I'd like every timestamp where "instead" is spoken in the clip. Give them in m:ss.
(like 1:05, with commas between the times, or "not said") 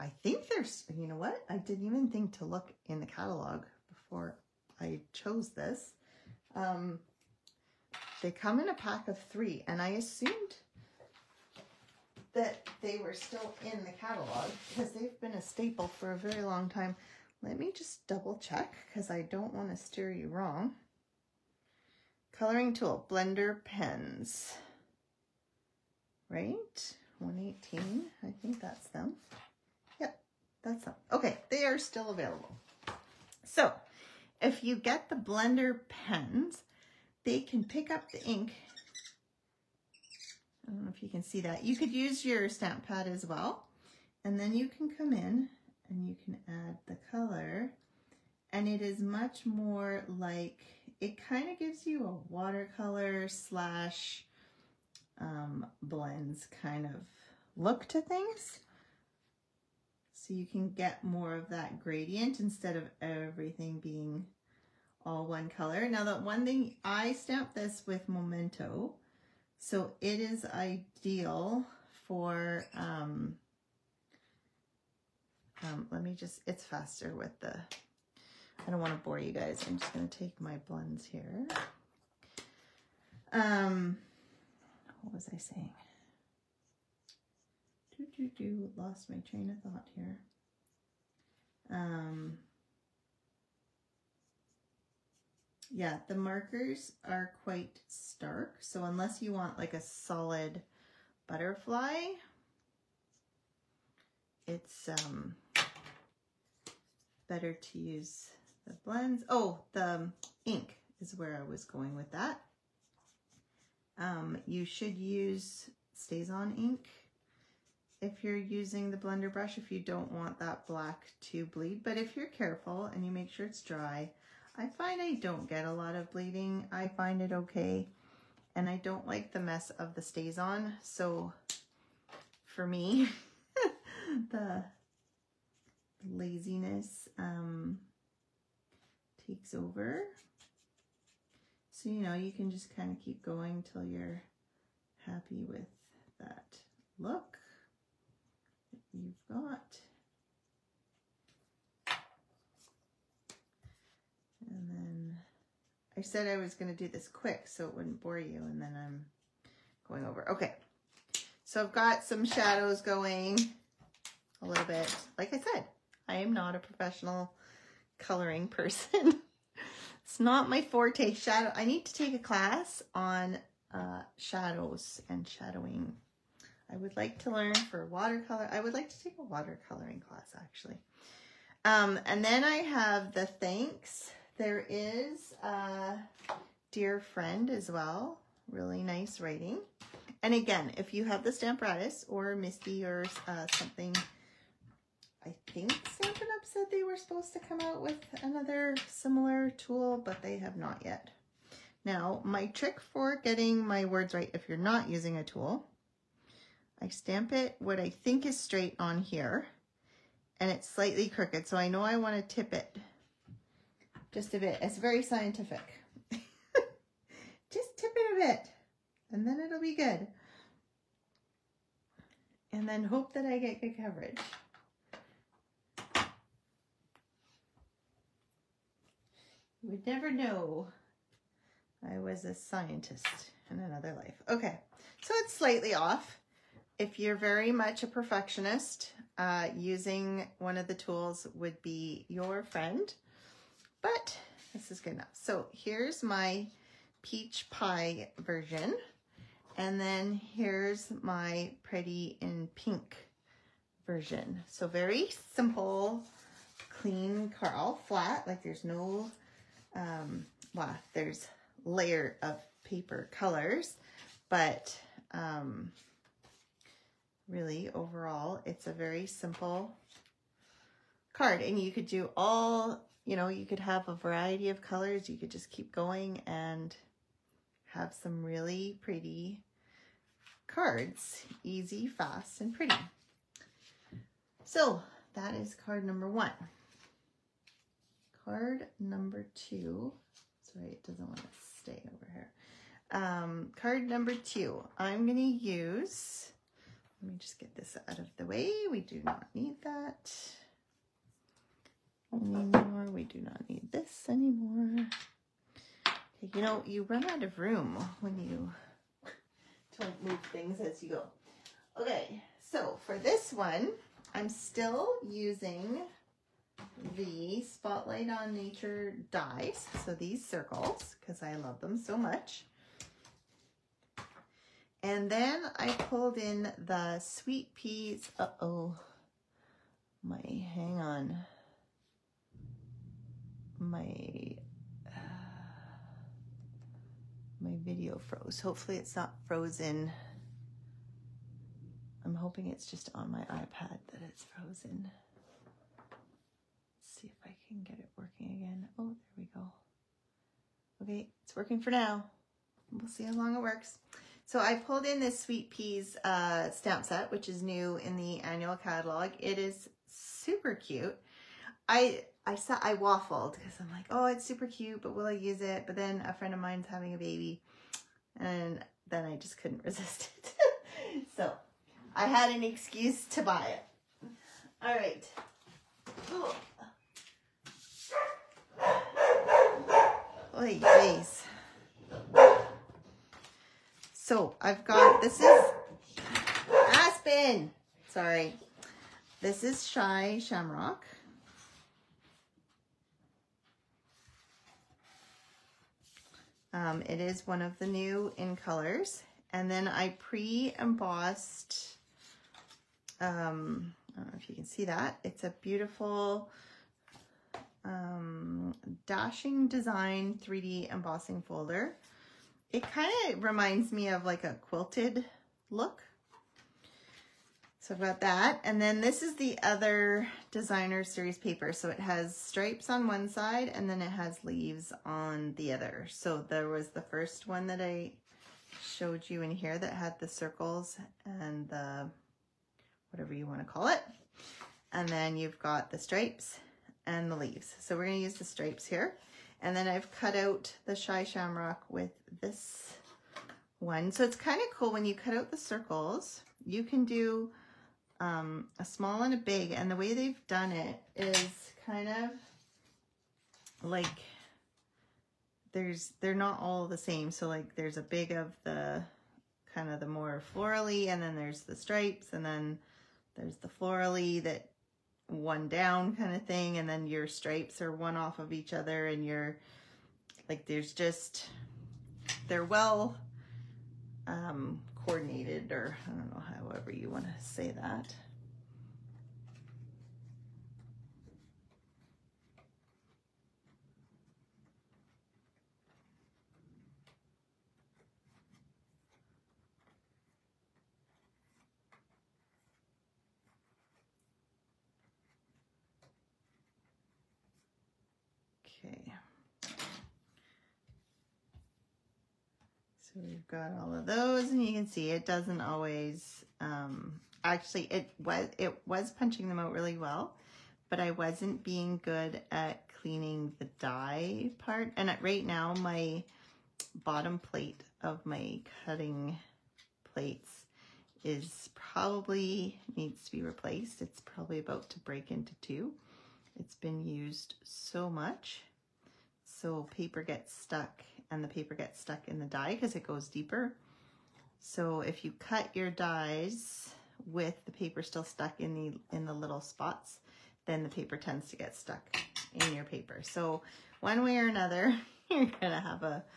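1:02.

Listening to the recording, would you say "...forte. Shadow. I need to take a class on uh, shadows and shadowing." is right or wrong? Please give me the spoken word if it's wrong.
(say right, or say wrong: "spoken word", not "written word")
right.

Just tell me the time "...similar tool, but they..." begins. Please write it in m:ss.
3:18.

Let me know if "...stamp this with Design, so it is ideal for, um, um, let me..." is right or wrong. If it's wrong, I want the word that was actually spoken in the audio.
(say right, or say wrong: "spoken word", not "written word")
wrong: "Memento", not "Design".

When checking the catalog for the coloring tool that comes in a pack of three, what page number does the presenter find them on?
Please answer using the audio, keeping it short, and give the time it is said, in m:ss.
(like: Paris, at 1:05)
118, at 0:27.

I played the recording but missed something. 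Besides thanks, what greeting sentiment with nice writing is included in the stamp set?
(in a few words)
Dear Friend.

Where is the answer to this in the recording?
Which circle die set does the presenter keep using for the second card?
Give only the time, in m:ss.
5:17.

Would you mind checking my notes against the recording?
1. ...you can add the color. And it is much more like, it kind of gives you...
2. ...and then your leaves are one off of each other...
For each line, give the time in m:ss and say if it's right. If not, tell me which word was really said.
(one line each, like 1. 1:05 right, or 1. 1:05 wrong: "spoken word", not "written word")
1. 0:46 right
2. 7:46 wrong: "stripes", not "leaves".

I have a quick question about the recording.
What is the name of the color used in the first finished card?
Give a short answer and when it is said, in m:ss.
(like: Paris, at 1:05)
Peach Pie, at 4:07.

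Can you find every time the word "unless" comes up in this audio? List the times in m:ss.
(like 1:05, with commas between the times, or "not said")
1:38.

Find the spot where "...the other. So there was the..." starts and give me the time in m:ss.
7:05.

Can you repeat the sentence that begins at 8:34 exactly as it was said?
And right now my bottom plate of my cutting plates is probably needs to be replaced.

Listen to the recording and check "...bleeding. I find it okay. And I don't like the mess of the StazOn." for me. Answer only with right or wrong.
right.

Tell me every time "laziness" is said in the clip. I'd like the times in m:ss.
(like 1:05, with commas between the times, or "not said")
2:16.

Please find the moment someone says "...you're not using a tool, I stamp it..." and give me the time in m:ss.
3:24.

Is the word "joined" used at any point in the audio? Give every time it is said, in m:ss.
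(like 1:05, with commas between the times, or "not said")
not said.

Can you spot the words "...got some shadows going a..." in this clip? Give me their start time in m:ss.
2:41.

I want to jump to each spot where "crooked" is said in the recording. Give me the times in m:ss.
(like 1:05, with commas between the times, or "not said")
3:31.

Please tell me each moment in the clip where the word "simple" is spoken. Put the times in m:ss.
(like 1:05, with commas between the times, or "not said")
4:15, 4:29.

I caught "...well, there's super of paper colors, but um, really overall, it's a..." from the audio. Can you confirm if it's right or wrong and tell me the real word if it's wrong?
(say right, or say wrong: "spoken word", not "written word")
wrong: "layer", not "super".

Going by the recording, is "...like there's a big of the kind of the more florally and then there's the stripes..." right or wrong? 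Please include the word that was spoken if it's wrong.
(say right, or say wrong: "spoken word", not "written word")
right.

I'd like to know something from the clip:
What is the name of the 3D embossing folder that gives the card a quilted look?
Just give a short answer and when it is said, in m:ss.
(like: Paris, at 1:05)
Dashing Design, at 6:48.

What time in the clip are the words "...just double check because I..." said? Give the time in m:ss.
0:17.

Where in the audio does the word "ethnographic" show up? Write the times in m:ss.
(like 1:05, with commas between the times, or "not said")
not said.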